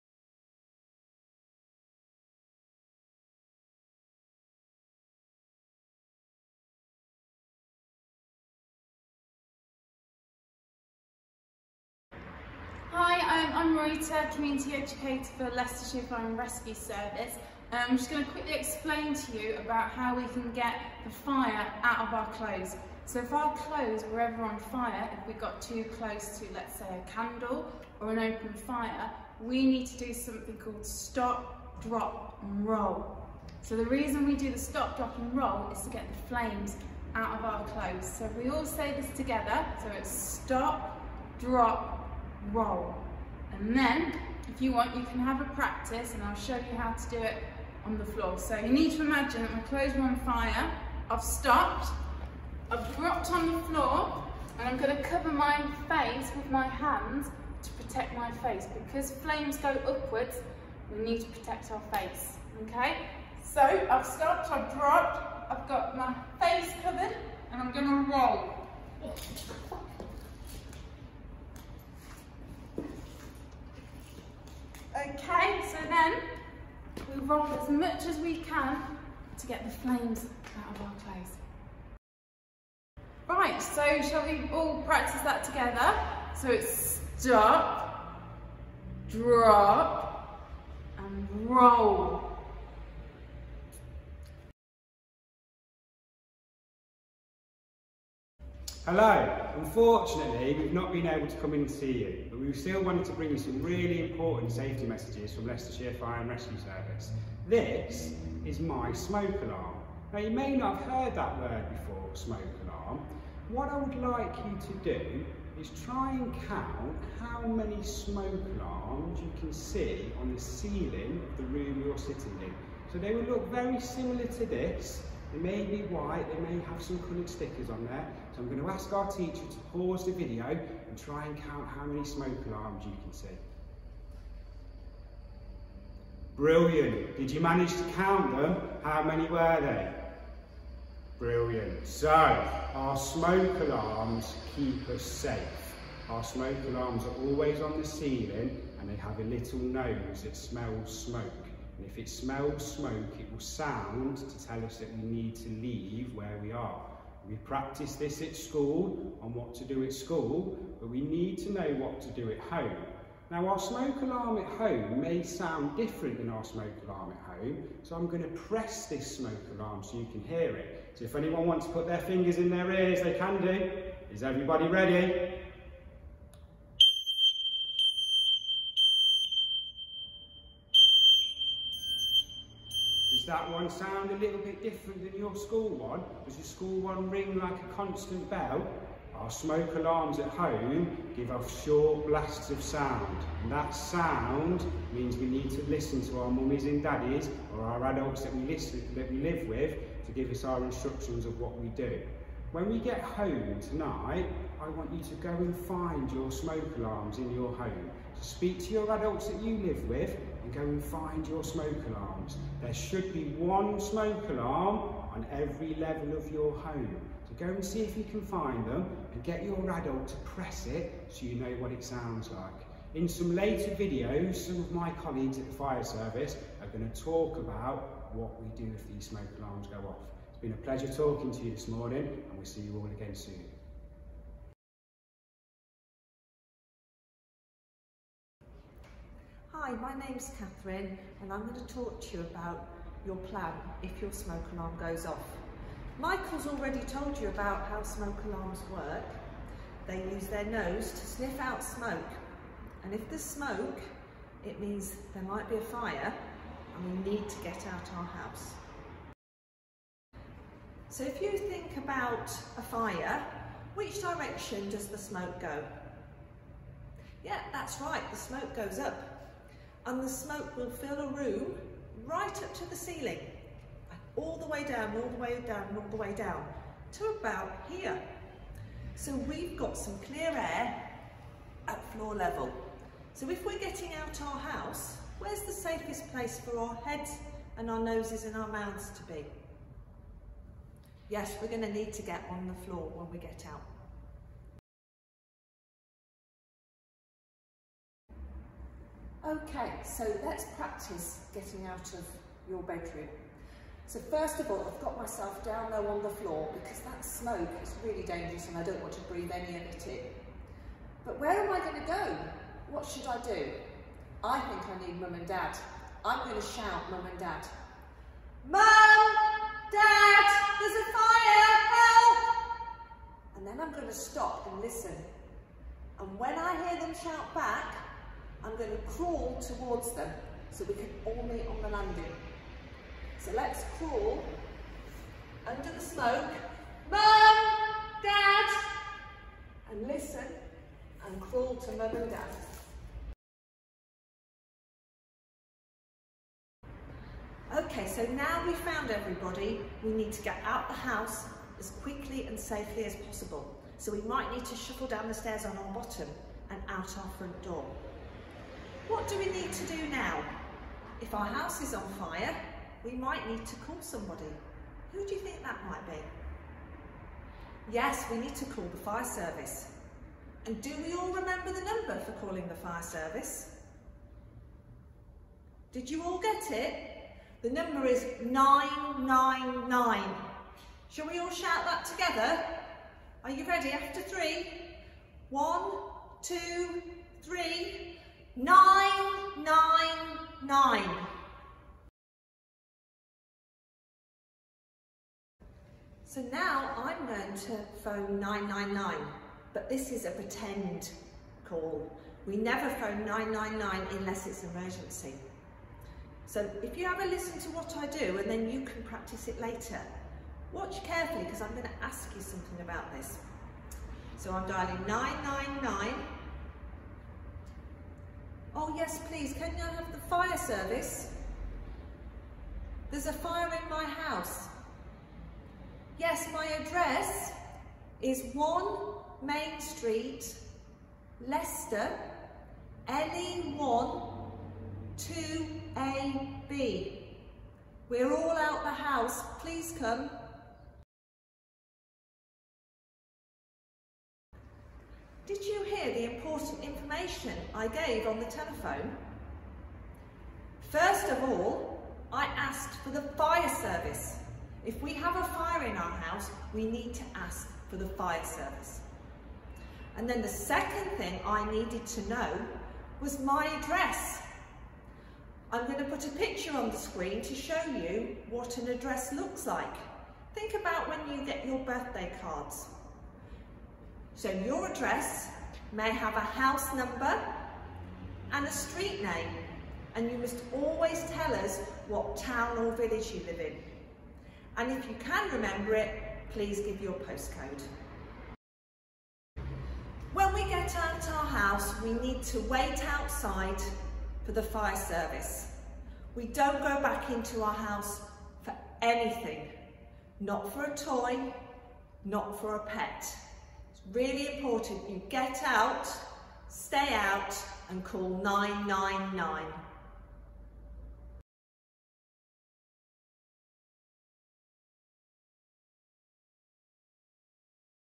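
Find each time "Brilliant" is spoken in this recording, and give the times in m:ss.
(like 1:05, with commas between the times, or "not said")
2:16, 2:21.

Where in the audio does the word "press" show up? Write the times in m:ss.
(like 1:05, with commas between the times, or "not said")
2:48, 3:40.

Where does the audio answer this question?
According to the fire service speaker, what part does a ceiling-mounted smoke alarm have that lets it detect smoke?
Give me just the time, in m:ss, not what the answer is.
2:29.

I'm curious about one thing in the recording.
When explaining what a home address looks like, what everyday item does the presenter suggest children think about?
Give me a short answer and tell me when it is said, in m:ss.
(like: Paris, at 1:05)
Birthday cards, at 7:51.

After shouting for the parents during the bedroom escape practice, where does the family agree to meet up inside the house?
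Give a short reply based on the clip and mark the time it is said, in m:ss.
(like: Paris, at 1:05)
On the landing, at 5:31.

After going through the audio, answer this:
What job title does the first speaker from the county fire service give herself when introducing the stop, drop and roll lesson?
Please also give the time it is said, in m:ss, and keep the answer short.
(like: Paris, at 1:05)
Community Educator, at 0:14.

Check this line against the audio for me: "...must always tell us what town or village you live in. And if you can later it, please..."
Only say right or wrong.
wrong.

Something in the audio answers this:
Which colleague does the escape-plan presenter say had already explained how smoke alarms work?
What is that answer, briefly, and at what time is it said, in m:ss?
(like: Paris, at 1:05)
Michael, at 4:05.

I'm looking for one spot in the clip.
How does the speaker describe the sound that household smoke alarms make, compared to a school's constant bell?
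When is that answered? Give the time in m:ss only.
3:11.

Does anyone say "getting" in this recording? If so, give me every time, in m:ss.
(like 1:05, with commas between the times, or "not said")
4:43, 5:01.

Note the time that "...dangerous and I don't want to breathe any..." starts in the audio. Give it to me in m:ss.
5:08.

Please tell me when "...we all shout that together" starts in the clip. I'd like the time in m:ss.
6:21.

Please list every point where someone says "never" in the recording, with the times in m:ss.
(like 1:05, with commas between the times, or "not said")
6:42.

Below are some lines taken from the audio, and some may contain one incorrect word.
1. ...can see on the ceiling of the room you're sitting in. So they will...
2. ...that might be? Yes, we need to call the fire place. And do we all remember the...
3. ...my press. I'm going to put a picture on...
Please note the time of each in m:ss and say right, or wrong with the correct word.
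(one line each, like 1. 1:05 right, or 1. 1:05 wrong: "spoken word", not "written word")
1. 1:59 right
2. 6:05 wrong: "service", not "place"
3. 7:43 wrong: "address", not "press".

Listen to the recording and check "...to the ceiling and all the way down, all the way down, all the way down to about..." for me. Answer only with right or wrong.
right.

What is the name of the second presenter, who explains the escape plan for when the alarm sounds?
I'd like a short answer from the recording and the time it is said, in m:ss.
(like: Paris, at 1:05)
Catherine, at 4:00.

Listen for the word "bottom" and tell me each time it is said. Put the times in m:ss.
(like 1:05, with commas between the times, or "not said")
5:55.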